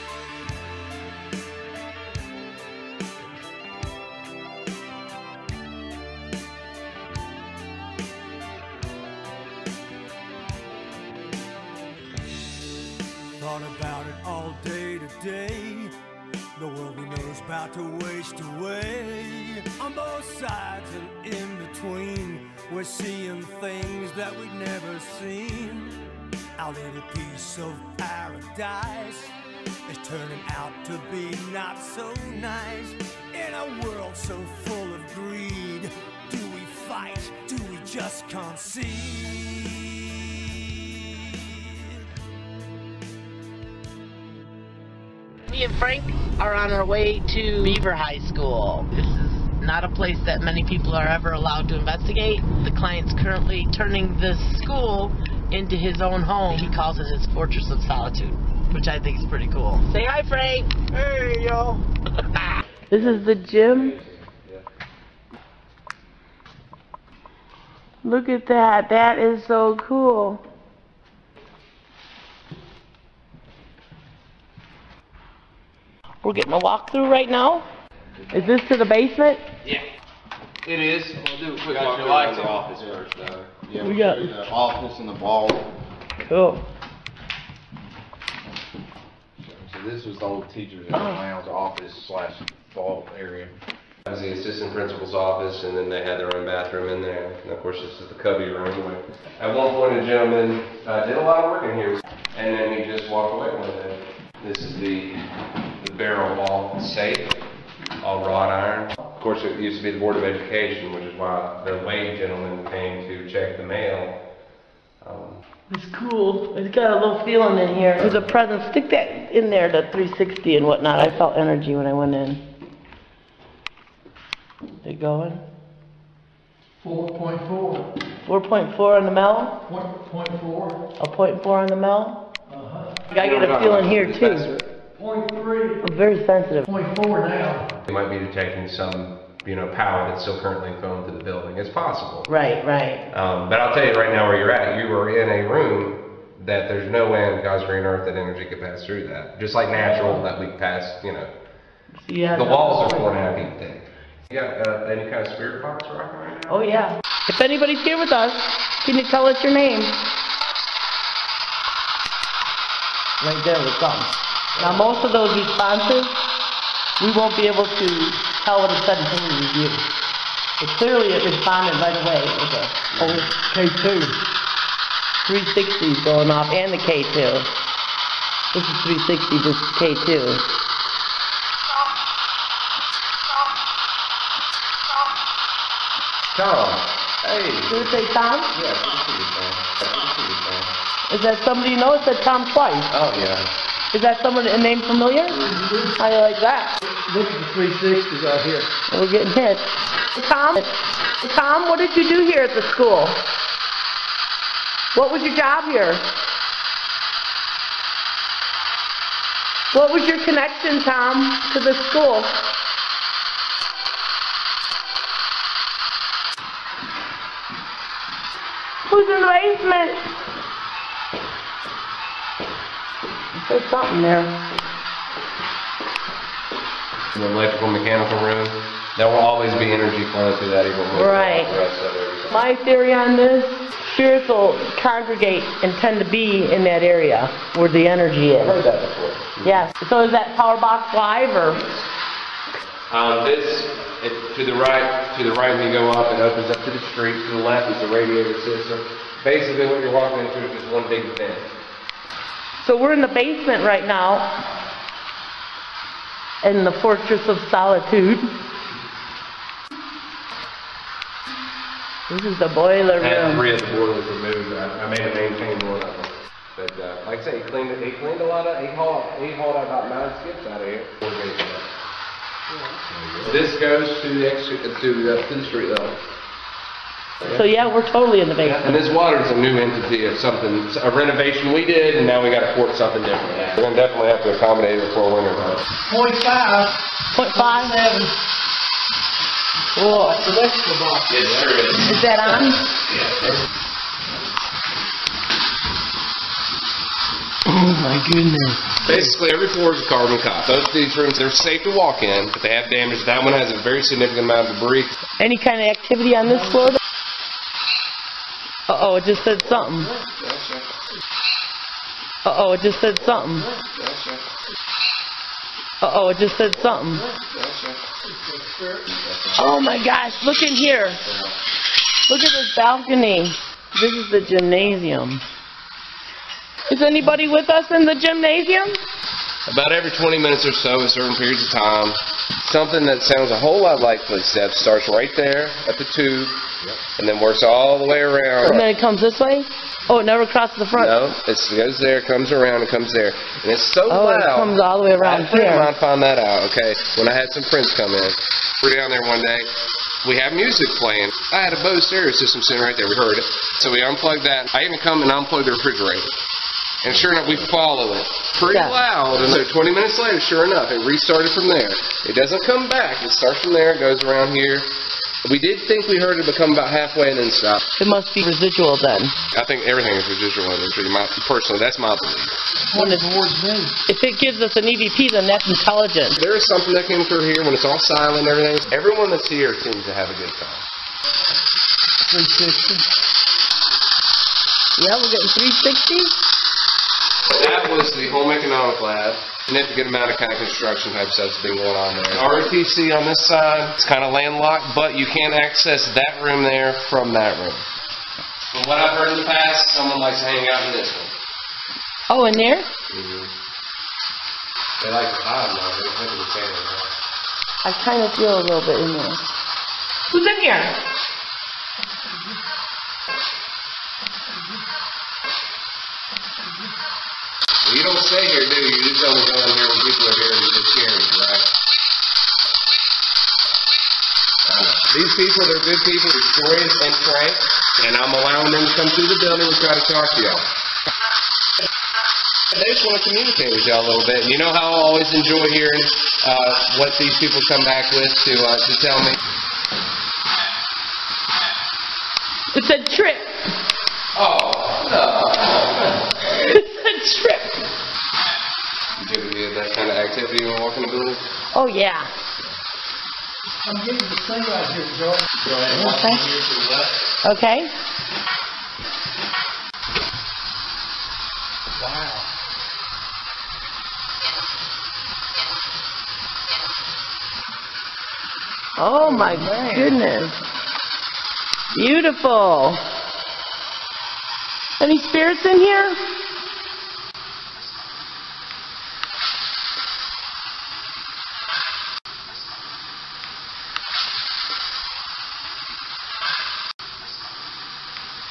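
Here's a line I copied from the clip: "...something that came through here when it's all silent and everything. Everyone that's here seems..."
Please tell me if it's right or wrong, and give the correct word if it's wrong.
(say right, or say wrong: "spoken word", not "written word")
right.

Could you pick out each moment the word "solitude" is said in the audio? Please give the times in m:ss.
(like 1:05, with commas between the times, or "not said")
0:57, 4:17.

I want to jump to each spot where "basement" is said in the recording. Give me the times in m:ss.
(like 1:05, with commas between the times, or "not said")
1:18, 3:39, 4:13, 4:38.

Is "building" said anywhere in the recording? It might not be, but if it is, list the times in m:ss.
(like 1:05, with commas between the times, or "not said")
2:21, 7:09, 7:30.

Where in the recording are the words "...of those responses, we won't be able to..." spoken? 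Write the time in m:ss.
2:45.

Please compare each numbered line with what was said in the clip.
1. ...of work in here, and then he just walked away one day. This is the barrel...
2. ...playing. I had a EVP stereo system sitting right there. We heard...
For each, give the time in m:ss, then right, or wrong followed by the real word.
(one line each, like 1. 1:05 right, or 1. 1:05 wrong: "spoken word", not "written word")
1. 1:41 right
2. 5:50 wrong: "Bose", not "EVP".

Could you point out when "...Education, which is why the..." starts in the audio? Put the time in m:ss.
1:50.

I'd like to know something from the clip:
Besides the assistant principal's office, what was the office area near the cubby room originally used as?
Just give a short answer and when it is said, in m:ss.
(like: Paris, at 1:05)
teacher's lounge, at 1:30.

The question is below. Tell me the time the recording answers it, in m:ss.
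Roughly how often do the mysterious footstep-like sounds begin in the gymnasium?
5:29.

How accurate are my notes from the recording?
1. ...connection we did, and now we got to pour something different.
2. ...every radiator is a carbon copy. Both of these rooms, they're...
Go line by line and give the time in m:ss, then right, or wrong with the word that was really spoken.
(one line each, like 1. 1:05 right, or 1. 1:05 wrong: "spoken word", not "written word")
1. 4:40 wrong: "renovation", not "connection"
2. 4:59 wrong: "floor", not "radiator".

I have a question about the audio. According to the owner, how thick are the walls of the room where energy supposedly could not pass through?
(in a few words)
4.5 feet.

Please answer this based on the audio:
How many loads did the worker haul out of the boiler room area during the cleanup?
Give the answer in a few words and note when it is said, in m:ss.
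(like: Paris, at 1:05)
9 skips, at 4:29.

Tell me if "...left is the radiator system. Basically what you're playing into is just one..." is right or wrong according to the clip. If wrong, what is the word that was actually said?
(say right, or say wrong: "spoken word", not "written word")
wrong: "walking", not "playing".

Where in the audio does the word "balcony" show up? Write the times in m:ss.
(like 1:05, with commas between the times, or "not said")
5:22.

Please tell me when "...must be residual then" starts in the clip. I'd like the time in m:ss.
6:07.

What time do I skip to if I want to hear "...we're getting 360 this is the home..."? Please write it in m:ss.
6:25.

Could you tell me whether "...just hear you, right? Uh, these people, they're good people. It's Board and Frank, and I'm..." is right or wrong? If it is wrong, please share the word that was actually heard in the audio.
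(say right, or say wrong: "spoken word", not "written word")
wrong: "Dorian", not "Board".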